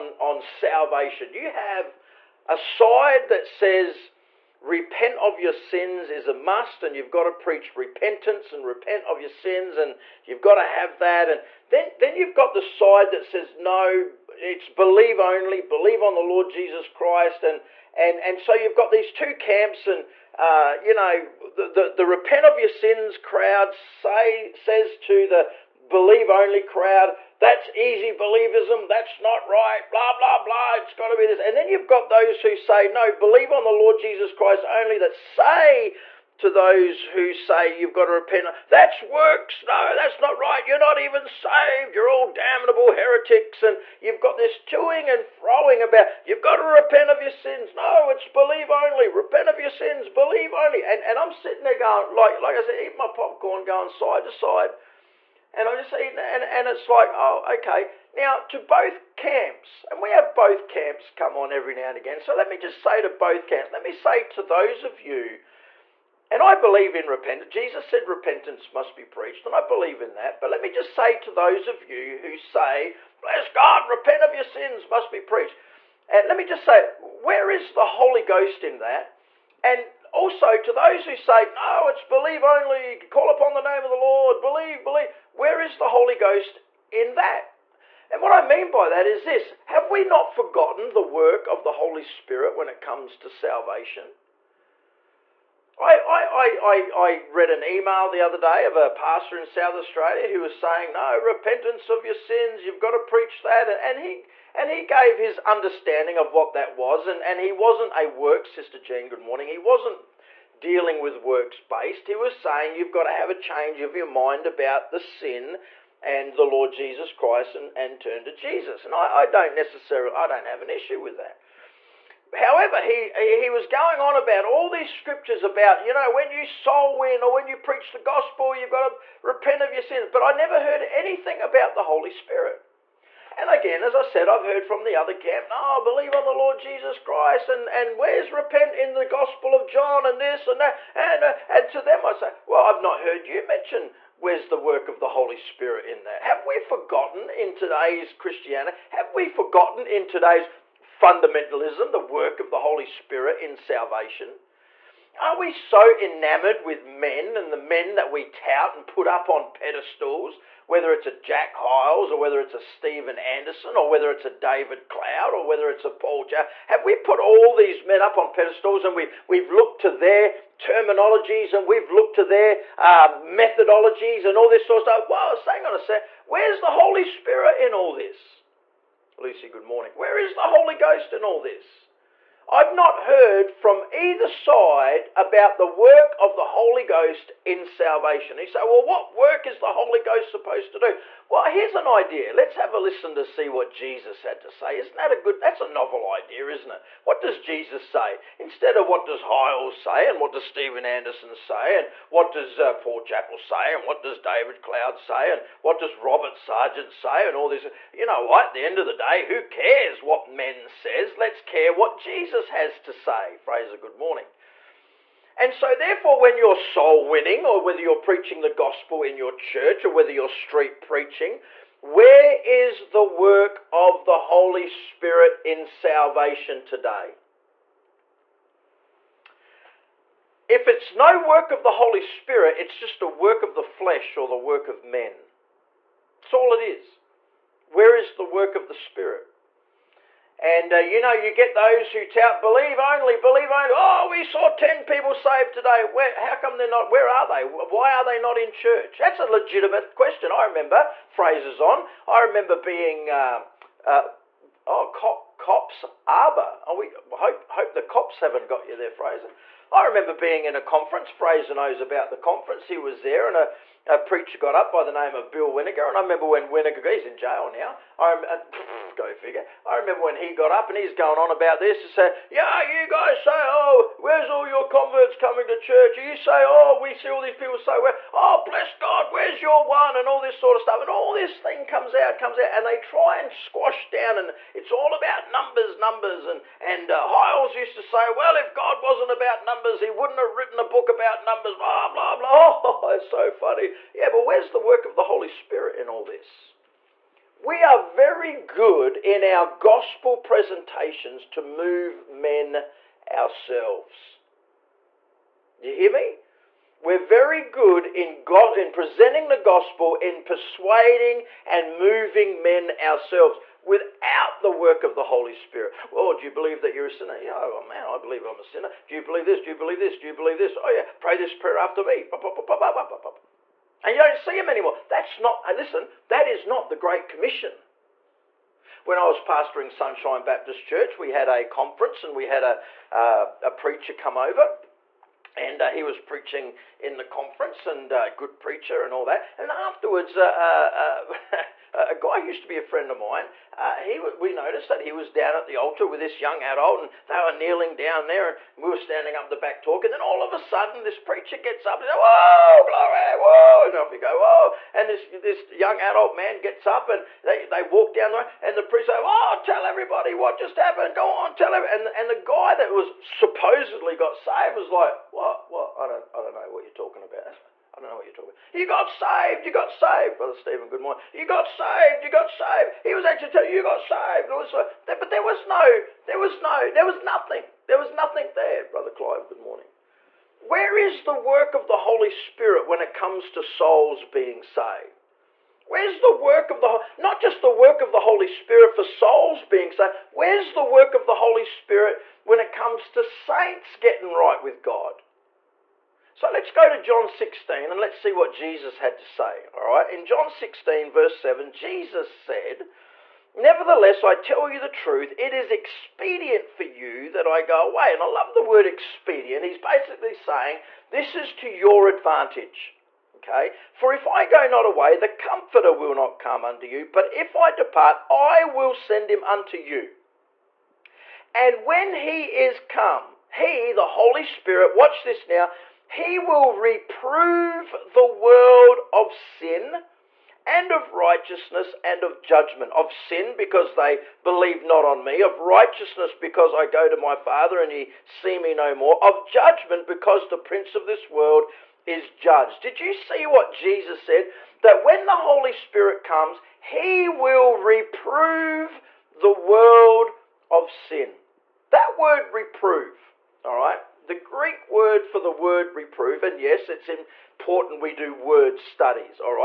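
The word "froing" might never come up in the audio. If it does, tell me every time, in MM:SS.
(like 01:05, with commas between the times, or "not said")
00:45.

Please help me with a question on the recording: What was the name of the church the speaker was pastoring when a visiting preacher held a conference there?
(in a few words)
Sunshine Baptist Church.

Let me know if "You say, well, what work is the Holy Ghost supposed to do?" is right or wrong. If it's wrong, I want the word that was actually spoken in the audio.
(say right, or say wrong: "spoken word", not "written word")
right.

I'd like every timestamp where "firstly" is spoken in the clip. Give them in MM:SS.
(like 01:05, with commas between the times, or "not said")
not said.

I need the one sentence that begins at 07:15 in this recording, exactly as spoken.
Of righteousness because I go to my Father and ye see me no more.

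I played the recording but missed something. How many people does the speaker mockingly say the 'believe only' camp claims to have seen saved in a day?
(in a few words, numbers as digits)
10.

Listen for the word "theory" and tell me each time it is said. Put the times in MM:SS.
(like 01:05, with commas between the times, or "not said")
not said.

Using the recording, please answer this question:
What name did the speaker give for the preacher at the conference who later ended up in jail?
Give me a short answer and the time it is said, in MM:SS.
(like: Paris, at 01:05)
Bill Winnegar, at 04:25.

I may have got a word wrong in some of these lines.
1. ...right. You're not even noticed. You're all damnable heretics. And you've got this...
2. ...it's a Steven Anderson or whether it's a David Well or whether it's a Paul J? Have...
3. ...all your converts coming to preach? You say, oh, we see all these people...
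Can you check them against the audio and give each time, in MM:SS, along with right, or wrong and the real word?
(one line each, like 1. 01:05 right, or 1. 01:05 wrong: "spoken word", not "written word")
1. 00:40 wrong: "saved", not "noticed"
2. 02:42 wrong: "Cloud", not "Well"
3. 04:34 wrong: "church", not "preach".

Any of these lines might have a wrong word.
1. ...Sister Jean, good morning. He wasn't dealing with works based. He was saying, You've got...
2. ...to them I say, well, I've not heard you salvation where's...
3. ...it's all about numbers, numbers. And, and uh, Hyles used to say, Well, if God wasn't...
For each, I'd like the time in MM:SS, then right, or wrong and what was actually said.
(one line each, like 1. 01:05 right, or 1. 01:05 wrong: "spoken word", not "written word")
1. 01:48 right
2. 02:21 wrong: "mention", not "salvation"
3. 04:44 right.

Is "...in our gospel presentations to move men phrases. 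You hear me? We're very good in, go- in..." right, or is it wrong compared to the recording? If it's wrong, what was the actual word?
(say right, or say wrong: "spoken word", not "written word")
wrong: "ourselves", not "phrases".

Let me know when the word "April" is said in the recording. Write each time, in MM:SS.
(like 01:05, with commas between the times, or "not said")
not said.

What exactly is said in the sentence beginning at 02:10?
But I never heard anything about the Holy Spirit.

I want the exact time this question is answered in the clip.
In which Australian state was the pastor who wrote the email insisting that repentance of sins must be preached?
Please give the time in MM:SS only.
01:39.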